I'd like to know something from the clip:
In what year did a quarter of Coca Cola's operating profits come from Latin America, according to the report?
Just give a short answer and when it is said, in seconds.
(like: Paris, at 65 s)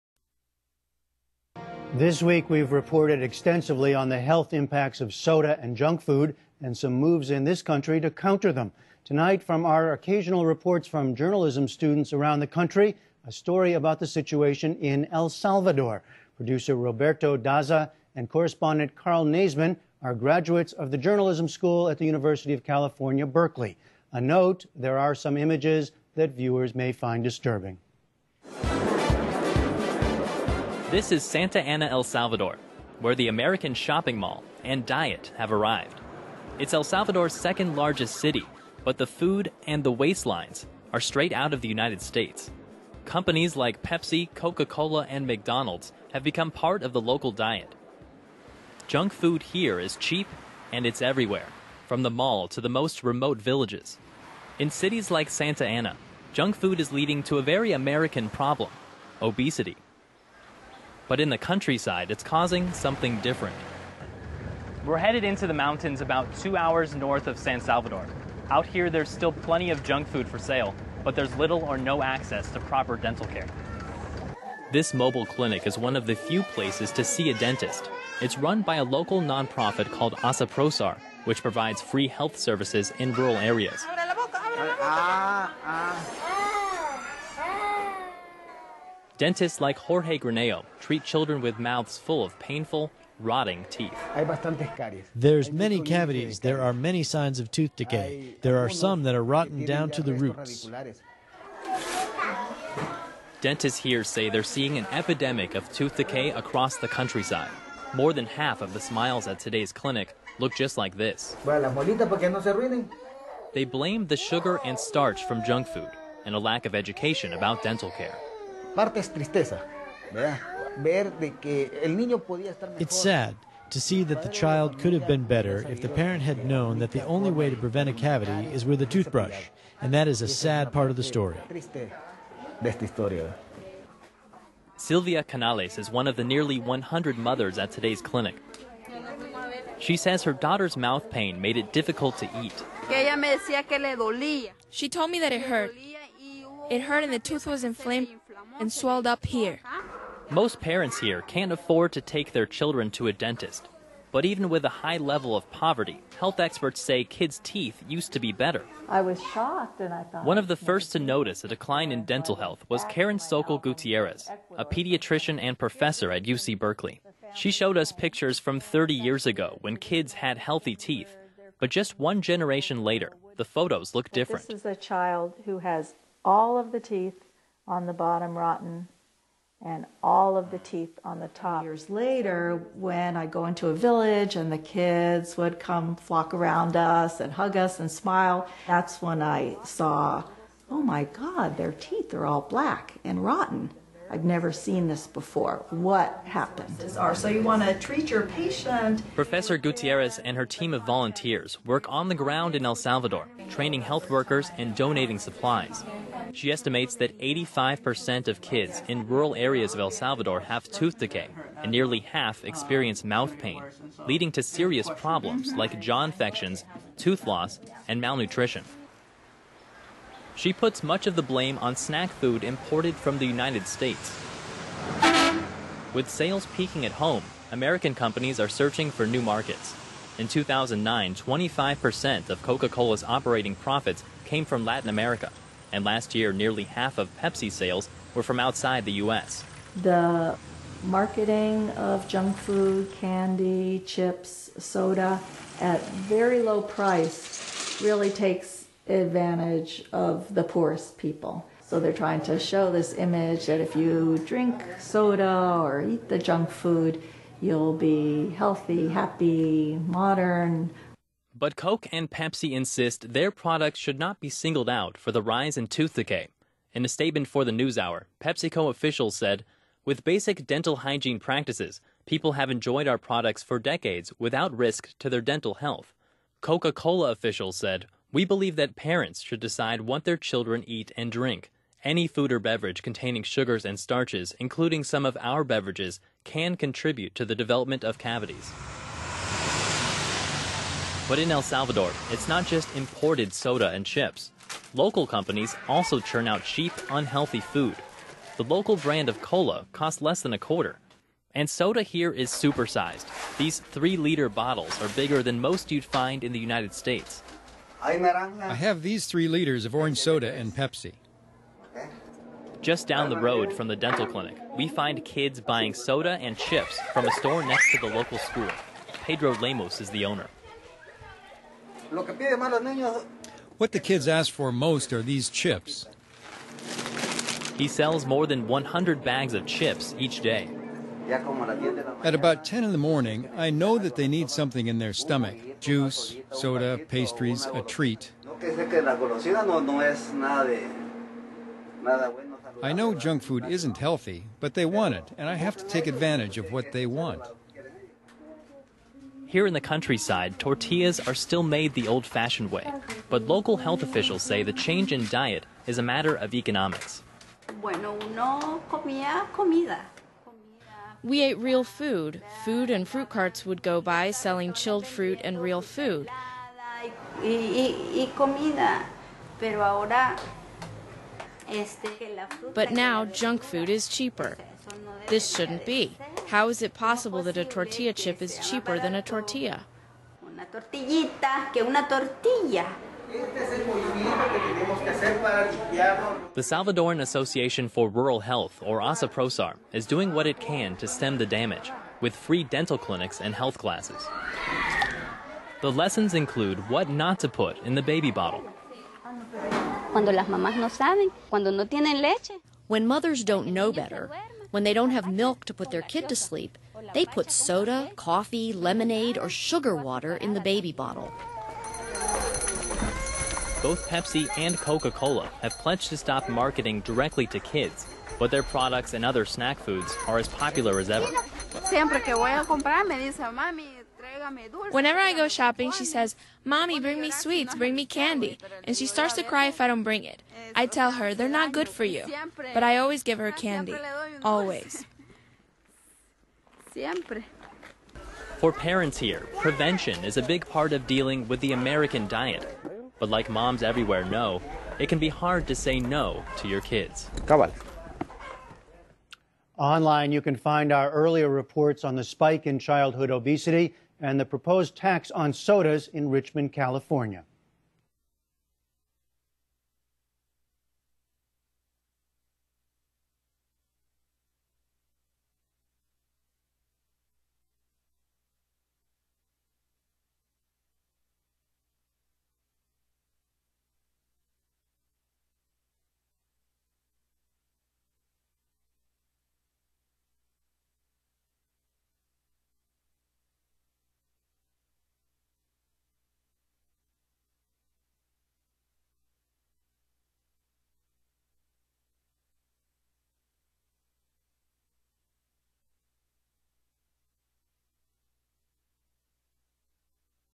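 2009, at 230 s.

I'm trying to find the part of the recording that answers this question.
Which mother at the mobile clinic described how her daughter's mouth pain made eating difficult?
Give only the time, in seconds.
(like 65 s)
134 s.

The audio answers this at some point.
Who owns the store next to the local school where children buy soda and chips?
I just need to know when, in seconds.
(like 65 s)
319 s.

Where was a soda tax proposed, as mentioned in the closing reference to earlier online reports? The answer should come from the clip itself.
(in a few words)
Richmond, California.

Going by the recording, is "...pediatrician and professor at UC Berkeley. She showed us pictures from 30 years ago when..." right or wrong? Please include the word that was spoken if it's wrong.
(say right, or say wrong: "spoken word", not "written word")
right.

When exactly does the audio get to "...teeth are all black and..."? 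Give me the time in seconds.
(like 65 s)
191 s.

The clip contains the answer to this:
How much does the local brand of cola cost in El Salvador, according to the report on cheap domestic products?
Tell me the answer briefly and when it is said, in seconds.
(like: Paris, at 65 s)
less than a quarter, at 300 s.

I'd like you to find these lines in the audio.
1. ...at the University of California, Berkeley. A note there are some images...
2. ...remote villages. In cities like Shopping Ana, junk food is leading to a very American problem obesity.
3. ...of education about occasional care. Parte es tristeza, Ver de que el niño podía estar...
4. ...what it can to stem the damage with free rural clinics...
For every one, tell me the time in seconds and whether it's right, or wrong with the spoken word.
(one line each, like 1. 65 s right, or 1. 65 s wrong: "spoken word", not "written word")
1. 21 s right
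2. 53 s wrong: "Santa", not "Shopping"
3. 116 s wrong: "dental", not "occasional"
4. 390 s wrong: "dental", not "rural".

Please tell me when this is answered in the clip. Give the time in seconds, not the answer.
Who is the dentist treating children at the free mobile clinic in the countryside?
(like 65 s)
89 s.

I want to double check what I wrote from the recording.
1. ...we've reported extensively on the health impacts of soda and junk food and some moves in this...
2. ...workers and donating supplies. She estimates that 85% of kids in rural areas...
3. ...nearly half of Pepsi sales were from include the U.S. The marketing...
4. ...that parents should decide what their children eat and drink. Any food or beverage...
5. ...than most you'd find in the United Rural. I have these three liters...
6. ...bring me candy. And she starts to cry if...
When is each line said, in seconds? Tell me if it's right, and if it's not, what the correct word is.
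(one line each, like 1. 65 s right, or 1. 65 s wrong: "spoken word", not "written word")
1. 2 s right
2. 204 s right
3. 236 s wrong: "outside", not "include"
4. 278 s right
5. 305 s wrong: "States", not "Rural"
6. 427 s right.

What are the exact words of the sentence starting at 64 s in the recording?
We're headed into the mountains about two hours north of San Salvador.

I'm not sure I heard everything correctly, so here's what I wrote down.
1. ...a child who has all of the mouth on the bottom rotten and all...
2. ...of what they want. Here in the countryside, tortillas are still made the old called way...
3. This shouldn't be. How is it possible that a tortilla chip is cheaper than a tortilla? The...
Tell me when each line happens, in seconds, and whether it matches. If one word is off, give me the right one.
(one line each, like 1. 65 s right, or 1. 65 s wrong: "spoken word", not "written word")
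1. 174 s wrong: "teeth", not "mouth"
2. 346 s wrong: "fashioned", not "called"
3. 375 s right.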